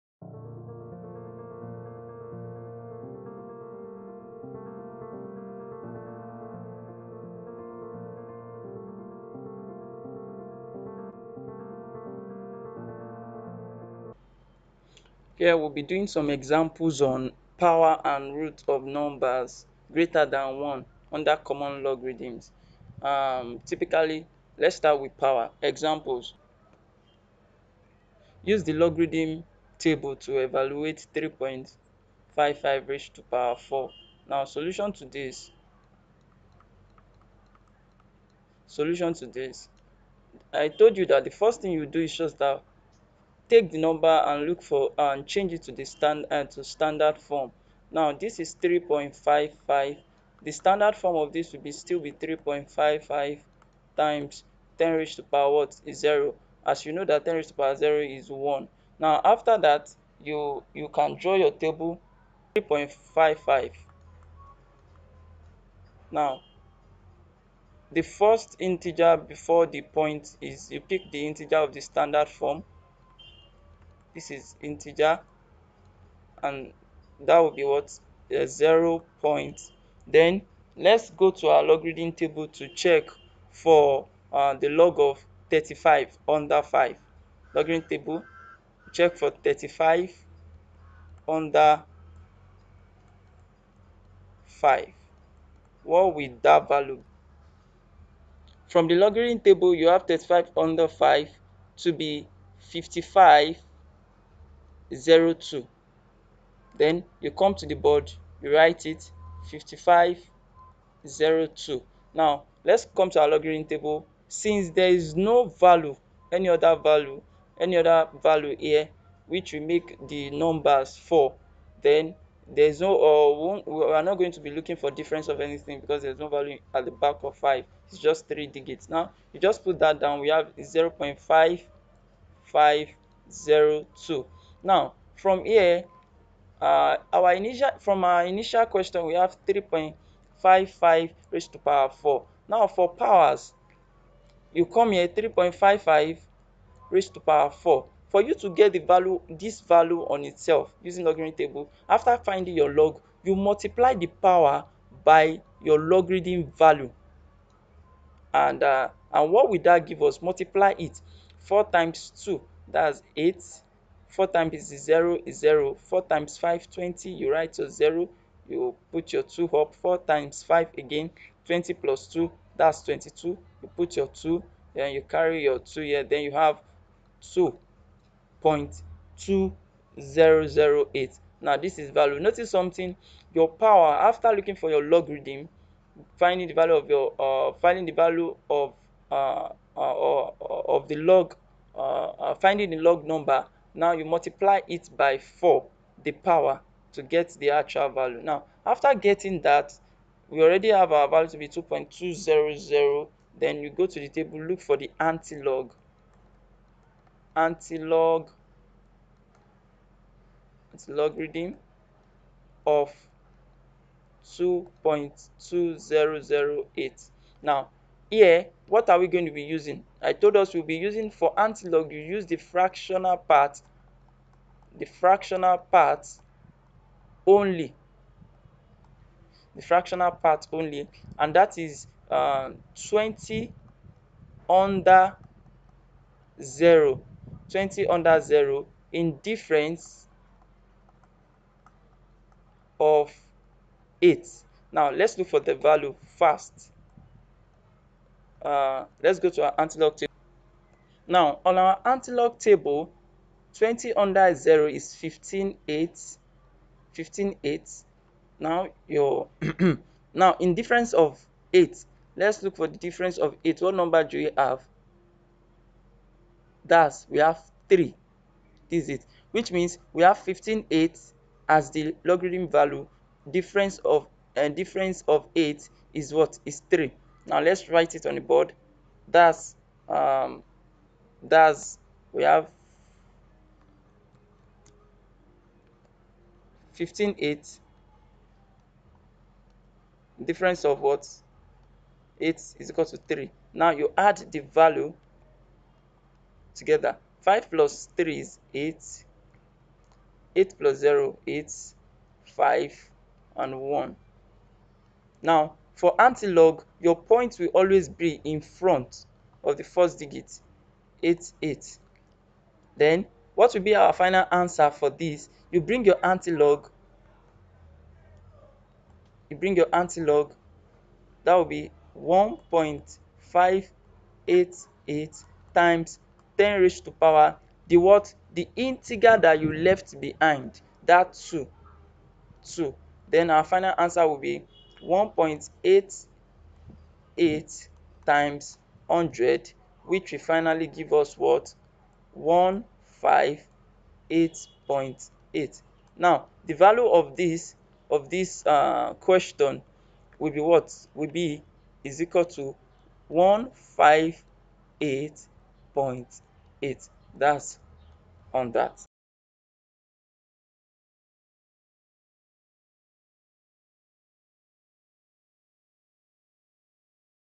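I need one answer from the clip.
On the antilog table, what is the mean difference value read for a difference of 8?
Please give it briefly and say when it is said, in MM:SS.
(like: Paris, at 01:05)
3, at 04:27.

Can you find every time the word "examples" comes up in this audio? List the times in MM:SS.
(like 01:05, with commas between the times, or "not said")
00:16, 00:25.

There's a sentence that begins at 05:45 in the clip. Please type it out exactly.
now the value of this of this uh, question will be what will be is equal to 158.8.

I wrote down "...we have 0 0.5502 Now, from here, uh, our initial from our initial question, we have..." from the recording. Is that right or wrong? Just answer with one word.
right.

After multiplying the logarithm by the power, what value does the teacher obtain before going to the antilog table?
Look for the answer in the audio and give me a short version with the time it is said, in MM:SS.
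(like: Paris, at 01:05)
2.2008, at 03:34.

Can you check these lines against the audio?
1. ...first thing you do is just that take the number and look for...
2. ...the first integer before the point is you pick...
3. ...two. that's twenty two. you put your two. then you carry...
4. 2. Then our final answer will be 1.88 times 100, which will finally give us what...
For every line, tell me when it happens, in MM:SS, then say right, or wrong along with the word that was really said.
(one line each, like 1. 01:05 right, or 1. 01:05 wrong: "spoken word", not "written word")
1. 00:41 right
2. 01:07 right
3. 02:52 right
4. 05:32 right.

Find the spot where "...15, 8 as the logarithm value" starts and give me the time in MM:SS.
04:30.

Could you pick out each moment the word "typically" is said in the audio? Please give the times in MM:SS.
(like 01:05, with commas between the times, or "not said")
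00:23.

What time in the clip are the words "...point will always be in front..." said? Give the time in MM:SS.
05:06.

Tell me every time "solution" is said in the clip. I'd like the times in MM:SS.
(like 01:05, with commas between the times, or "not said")
00:34, 00:38.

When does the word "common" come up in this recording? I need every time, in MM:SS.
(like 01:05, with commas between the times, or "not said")
00:21.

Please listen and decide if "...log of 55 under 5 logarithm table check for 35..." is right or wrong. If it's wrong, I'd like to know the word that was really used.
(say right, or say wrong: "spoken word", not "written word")
wrong: "35", not "55".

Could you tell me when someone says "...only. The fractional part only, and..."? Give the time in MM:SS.
03:47.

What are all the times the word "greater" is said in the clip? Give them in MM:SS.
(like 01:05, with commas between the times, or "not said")
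00:19.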